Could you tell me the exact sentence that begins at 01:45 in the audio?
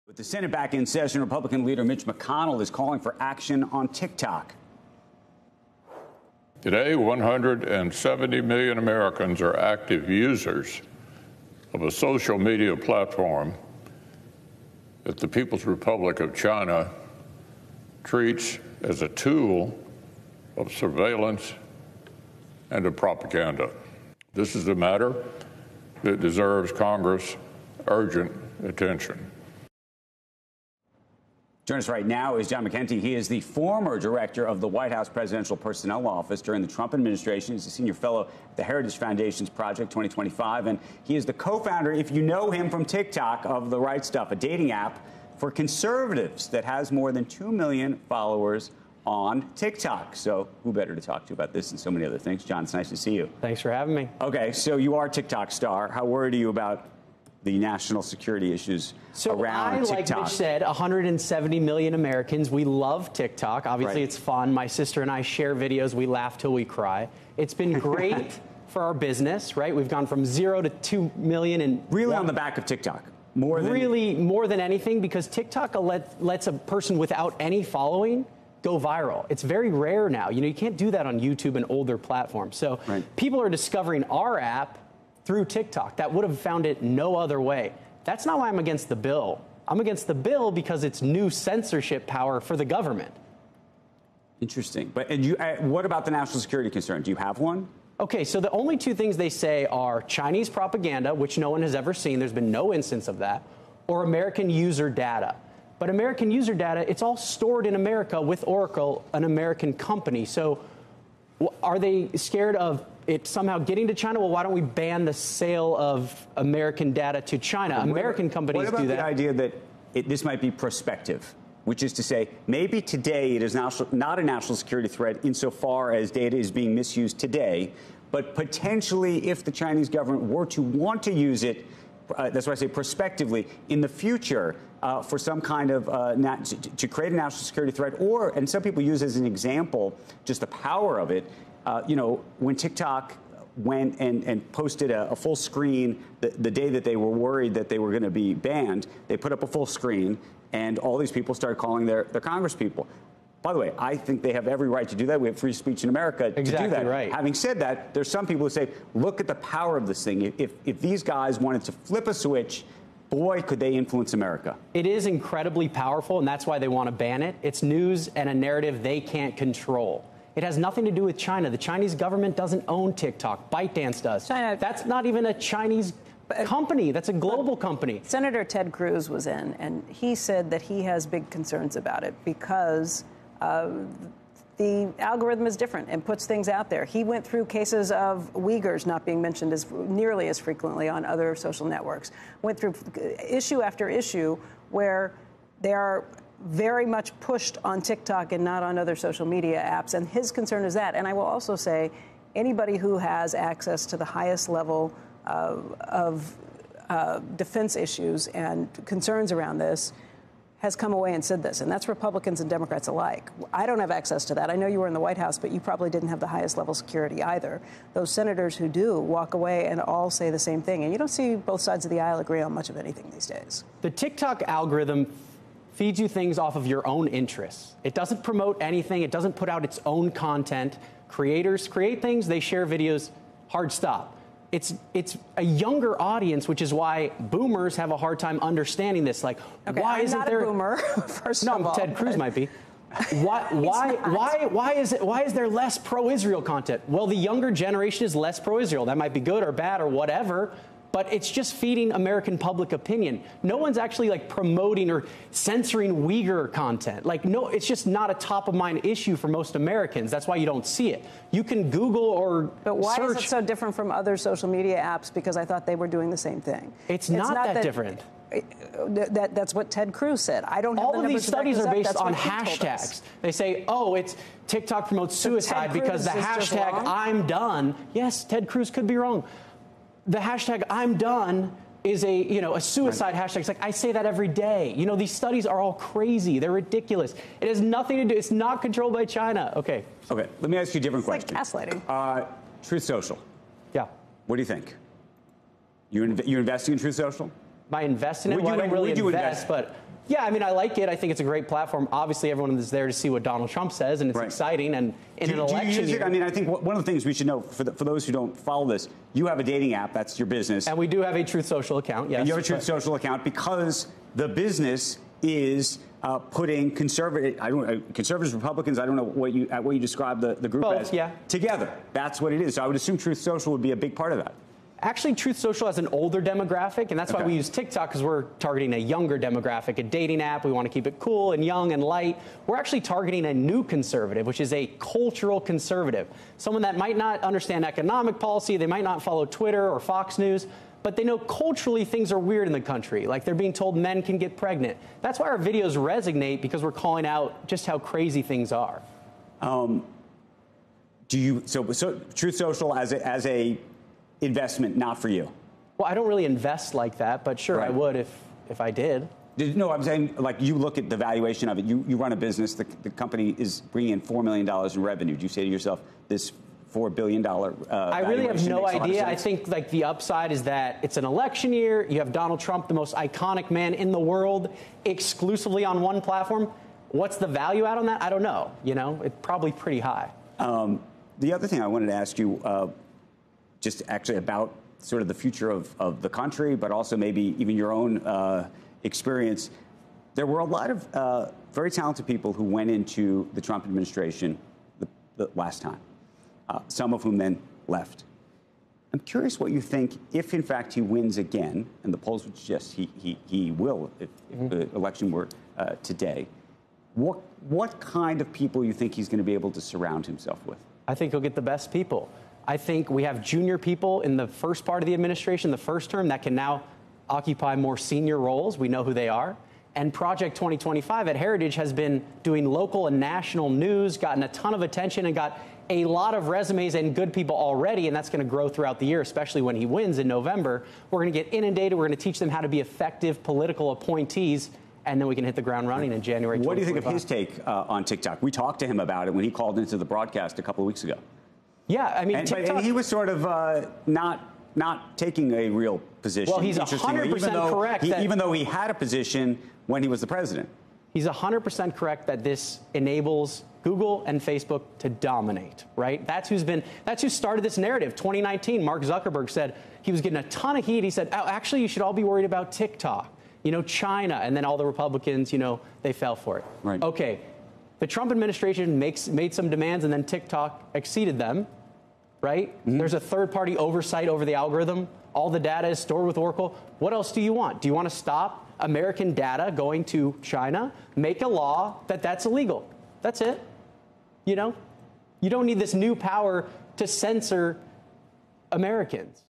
But American user data, it's all stored in America with Oracle, an American company.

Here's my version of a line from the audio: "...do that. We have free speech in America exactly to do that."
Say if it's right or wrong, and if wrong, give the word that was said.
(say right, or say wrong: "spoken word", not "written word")
right.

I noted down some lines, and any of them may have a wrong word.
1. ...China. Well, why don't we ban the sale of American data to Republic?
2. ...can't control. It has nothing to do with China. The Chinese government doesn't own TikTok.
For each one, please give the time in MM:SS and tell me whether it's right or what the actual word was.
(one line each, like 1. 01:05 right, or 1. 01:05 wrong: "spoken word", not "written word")
1. 01:53 wrong: "China", not "Republic"
2. 02:49 right.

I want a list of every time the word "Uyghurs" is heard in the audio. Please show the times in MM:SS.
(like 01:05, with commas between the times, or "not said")
03:08, 04:16.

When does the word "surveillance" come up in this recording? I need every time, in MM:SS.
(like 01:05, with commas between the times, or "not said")
00:20.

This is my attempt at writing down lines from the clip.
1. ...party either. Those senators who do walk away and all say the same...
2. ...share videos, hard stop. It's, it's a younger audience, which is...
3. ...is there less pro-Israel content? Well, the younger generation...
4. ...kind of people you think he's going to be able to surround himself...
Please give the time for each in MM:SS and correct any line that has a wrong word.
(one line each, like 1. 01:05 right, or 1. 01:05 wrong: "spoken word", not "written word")
1. 03:36 wrong: "security", not "party"
2. 03:52 right
3. 04:05 right
4. 06:47 right.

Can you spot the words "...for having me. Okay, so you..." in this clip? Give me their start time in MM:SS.
00:53.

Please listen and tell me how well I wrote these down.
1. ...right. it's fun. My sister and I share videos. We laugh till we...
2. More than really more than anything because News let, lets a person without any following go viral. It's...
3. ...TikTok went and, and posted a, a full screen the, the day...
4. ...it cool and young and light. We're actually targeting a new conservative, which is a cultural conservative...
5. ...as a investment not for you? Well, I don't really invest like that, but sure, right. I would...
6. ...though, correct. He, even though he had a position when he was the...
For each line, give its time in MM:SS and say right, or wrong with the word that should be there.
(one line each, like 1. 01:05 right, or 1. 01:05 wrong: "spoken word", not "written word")
1. 01:04 right
2. 01:13 wrong: "TikTok", not "News"
3. 02:22 right
4. 05:30 right
5. 05:53 right
6. 07:27 right.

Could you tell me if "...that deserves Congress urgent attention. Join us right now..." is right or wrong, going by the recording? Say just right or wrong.
right.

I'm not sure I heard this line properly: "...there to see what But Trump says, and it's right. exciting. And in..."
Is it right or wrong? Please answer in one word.
wrong.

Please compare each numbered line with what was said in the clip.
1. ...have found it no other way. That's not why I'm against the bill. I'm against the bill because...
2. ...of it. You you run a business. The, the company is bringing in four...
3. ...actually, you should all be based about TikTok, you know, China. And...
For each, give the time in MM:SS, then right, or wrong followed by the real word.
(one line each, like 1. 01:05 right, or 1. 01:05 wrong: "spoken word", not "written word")
1. 01:26 right
2. 06:01 right
3. 07:41 wrong: "worried", not "based".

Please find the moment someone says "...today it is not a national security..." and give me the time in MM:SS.
02:02.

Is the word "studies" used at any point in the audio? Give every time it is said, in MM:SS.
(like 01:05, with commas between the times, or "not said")
04:31, 04:45.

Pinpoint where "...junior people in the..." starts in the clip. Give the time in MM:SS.
06:53.